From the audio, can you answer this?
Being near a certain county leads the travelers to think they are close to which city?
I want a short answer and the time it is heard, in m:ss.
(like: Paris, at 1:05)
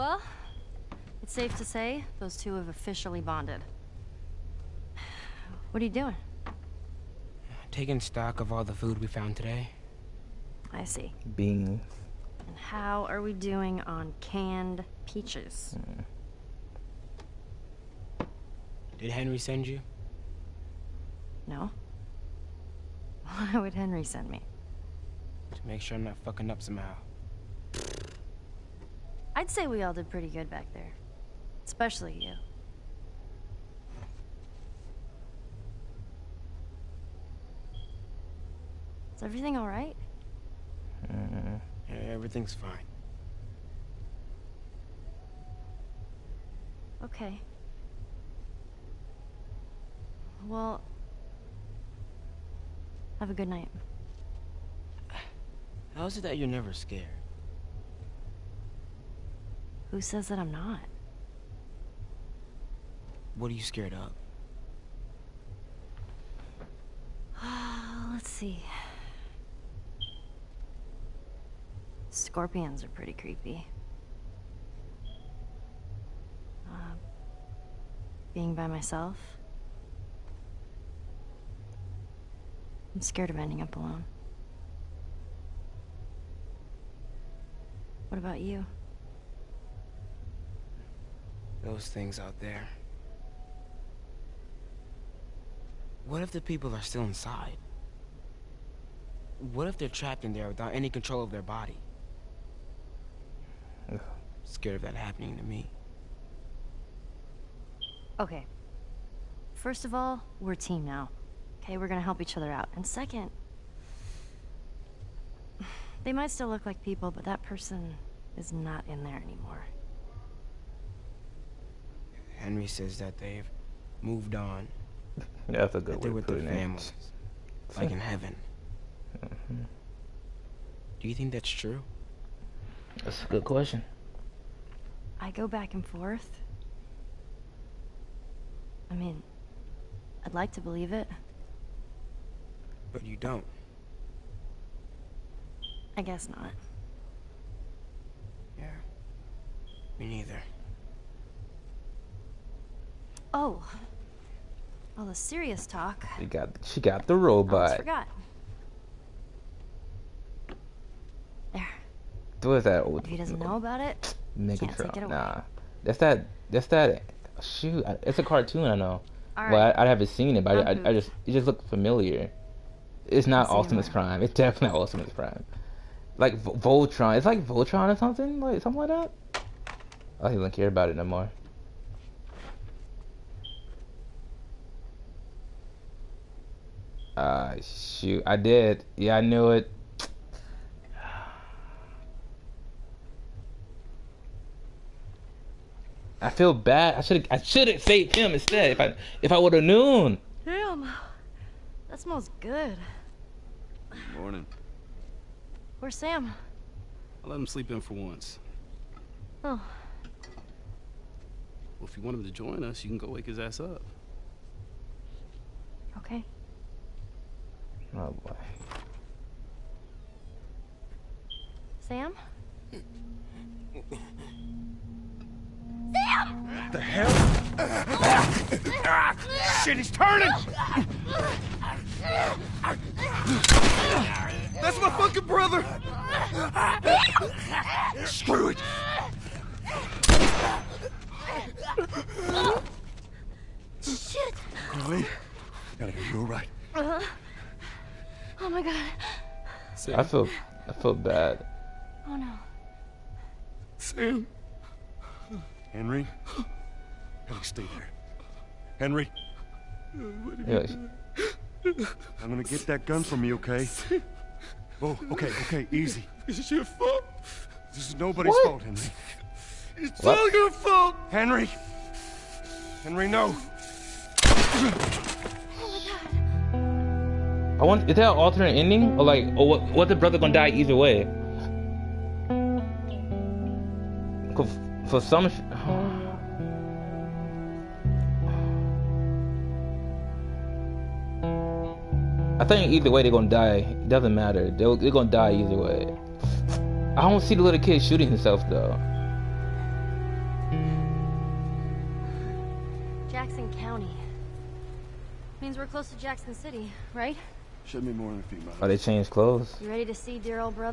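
Jackson City, at 5:05.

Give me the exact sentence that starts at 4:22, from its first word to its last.
I'm gonna get that gun from you, okay?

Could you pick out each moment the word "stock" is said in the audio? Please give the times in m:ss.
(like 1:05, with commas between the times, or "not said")
0:07.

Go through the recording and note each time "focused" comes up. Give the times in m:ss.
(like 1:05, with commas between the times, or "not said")
not said.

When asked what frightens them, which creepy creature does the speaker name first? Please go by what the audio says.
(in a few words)
Scorpions.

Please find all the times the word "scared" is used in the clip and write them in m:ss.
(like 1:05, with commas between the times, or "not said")
0:56, 1:03, 1:23, 1:44.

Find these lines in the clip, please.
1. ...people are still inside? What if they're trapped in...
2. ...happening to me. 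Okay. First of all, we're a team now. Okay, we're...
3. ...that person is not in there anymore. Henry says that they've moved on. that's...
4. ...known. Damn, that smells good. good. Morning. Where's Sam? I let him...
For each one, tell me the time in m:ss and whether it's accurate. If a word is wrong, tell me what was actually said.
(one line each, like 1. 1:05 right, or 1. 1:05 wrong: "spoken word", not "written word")
1. 1:36 right
2. 1:44 right
3. 1:57 right
4. 3:19 right.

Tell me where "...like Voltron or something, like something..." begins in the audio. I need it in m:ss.
2:57.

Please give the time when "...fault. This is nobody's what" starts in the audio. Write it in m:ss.
4:26.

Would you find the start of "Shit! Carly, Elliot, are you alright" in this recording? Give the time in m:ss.
4:03.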